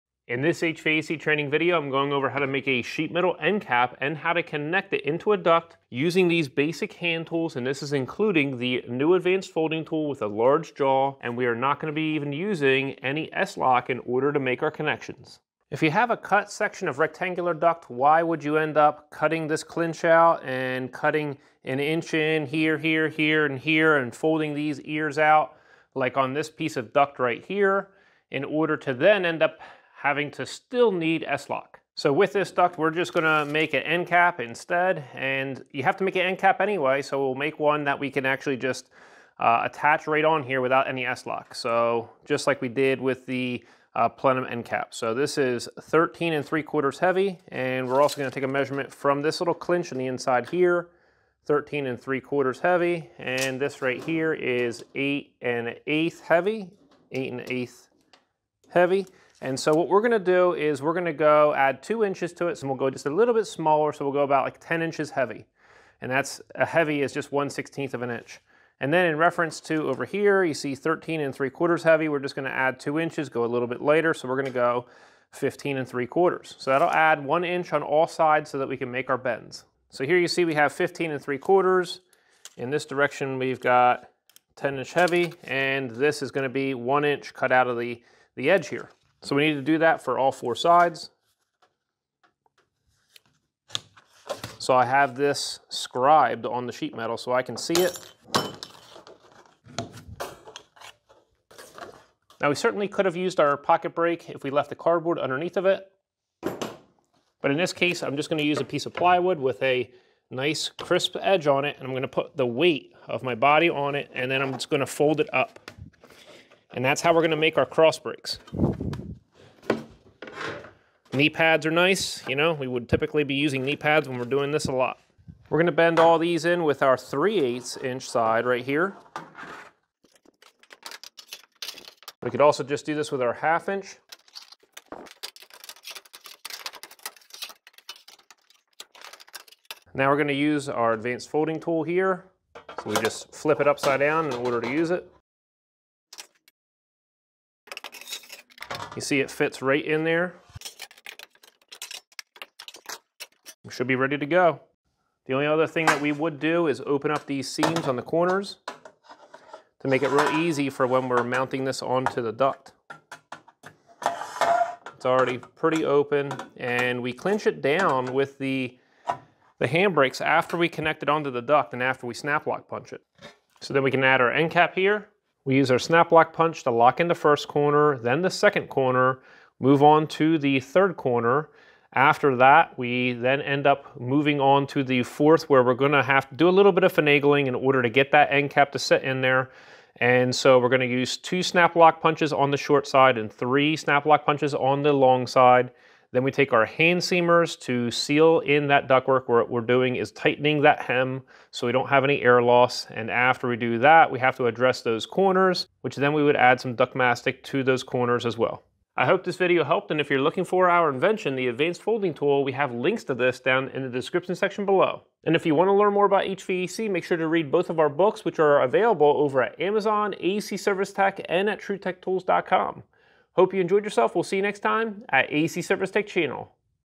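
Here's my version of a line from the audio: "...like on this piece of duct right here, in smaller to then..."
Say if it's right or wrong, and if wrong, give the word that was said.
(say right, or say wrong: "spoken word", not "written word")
wrong: "order", not "smaller".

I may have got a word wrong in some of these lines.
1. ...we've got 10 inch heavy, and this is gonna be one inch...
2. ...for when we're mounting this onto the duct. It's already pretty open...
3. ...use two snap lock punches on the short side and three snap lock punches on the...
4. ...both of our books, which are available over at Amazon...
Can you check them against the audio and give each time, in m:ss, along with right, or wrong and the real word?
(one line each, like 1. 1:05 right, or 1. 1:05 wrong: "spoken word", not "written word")
1. 1:23 right
2. 2:40 right
3. 3:10 right
4. 3:37 right.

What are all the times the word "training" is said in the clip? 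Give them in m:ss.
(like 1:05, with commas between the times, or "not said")
0:01.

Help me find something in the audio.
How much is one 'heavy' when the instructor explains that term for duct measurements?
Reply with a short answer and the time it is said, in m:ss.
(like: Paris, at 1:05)
1/16 of an inch, at 1:07.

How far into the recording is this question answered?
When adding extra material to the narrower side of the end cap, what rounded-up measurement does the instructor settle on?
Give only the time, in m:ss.
1:04.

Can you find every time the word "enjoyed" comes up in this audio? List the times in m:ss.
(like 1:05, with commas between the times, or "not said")
3:43.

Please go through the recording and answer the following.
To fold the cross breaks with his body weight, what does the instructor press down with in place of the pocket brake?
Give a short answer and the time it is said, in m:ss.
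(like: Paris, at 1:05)
plywood, at 1:48.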